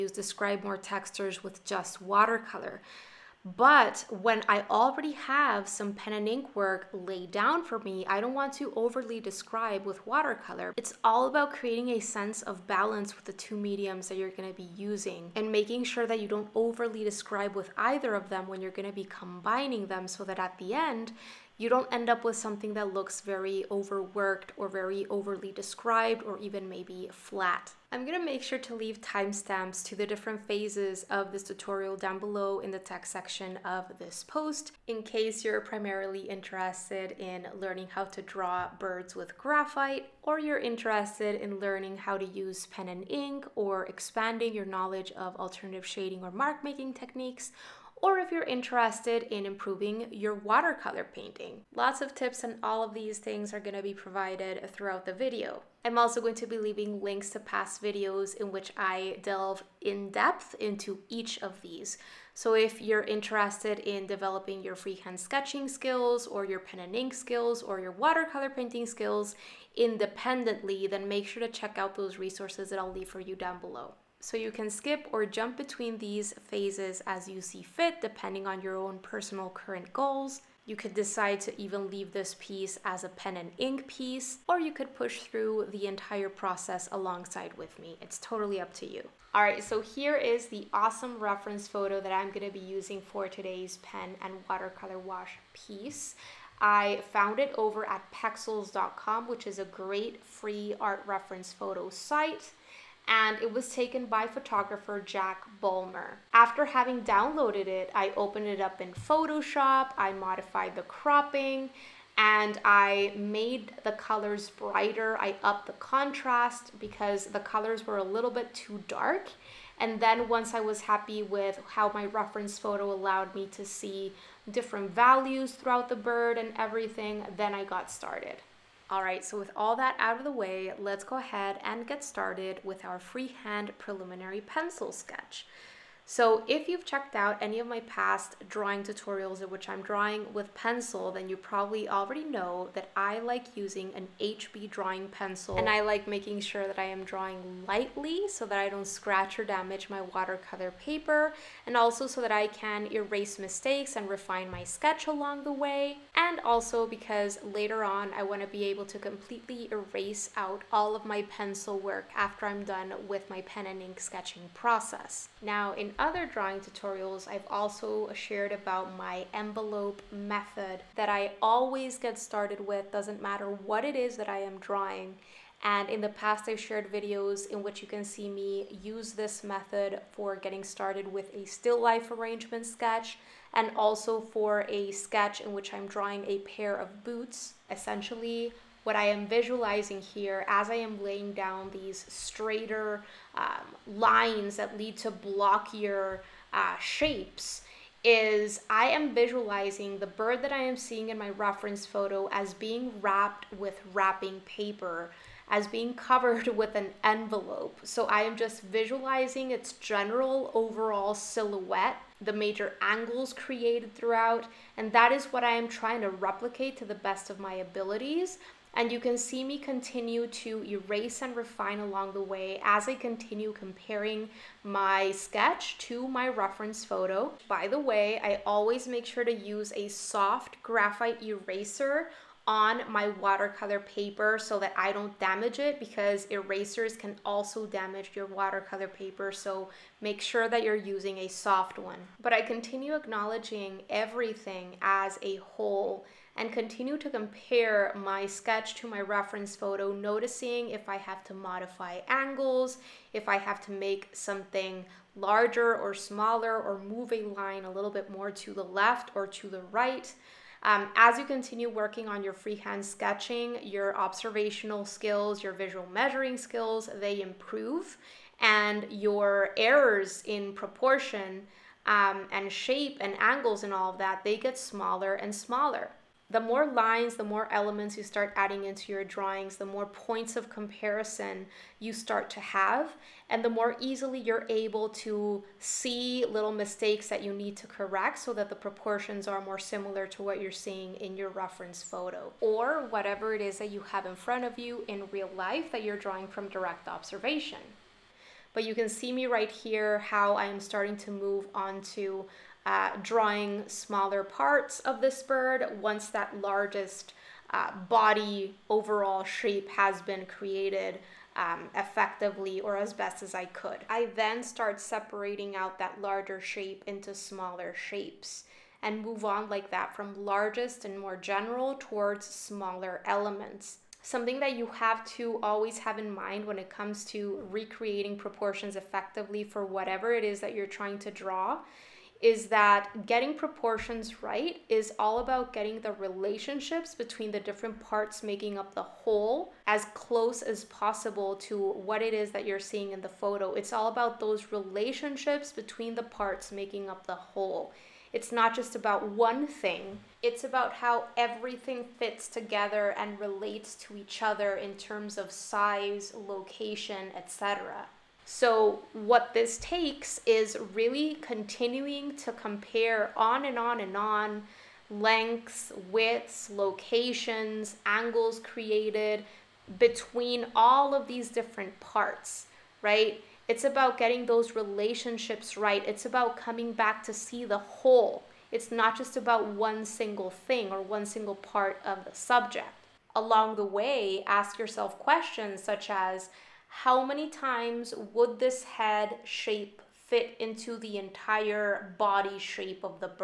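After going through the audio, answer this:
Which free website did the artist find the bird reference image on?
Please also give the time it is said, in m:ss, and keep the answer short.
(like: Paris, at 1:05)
pexels.com, at 1:38.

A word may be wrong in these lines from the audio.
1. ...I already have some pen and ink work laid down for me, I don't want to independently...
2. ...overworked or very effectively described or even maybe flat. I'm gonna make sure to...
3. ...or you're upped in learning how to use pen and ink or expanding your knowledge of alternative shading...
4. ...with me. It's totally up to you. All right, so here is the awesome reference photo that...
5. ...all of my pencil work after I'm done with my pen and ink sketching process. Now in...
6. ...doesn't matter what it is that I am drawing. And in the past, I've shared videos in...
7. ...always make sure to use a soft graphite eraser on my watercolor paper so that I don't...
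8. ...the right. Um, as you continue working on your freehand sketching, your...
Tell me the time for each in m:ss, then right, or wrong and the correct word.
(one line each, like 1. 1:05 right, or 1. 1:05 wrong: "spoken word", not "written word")
1. 0:04 wrong: "overly", not "independently"
2. 0:23 wrong: "overly", not "effectively"
3. 0:40 wrong: "interested", not "upped"
4. 1:27 right
5. 2:40 right
6. 2:52 right
7. 3:48 right
8. 4:19 right.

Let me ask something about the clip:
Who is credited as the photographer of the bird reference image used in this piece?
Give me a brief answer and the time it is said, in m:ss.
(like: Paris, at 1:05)
Jack Bulmer, at 1:45.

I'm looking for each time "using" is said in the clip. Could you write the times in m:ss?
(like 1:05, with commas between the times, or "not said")
0:14, 1:32, 2:23, 4:00.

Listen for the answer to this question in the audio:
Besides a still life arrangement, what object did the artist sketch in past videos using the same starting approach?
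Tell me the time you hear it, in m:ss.
3:06.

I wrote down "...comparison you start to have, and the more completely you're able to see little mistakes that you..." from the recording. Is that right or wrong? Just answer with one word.
wrong.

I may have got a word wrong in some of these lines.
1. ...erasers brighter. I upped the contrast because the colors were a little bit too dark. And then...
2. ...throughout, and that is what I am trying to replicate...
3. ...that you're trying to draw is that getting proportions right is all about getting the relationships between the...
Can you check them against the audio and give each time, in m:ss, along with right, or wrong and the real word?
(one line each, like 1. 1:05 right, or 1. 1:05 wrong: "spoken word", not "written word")
1. 1:53 wrong: "colors", not "erasers"
2. 3:33 right
3. 5:30 right.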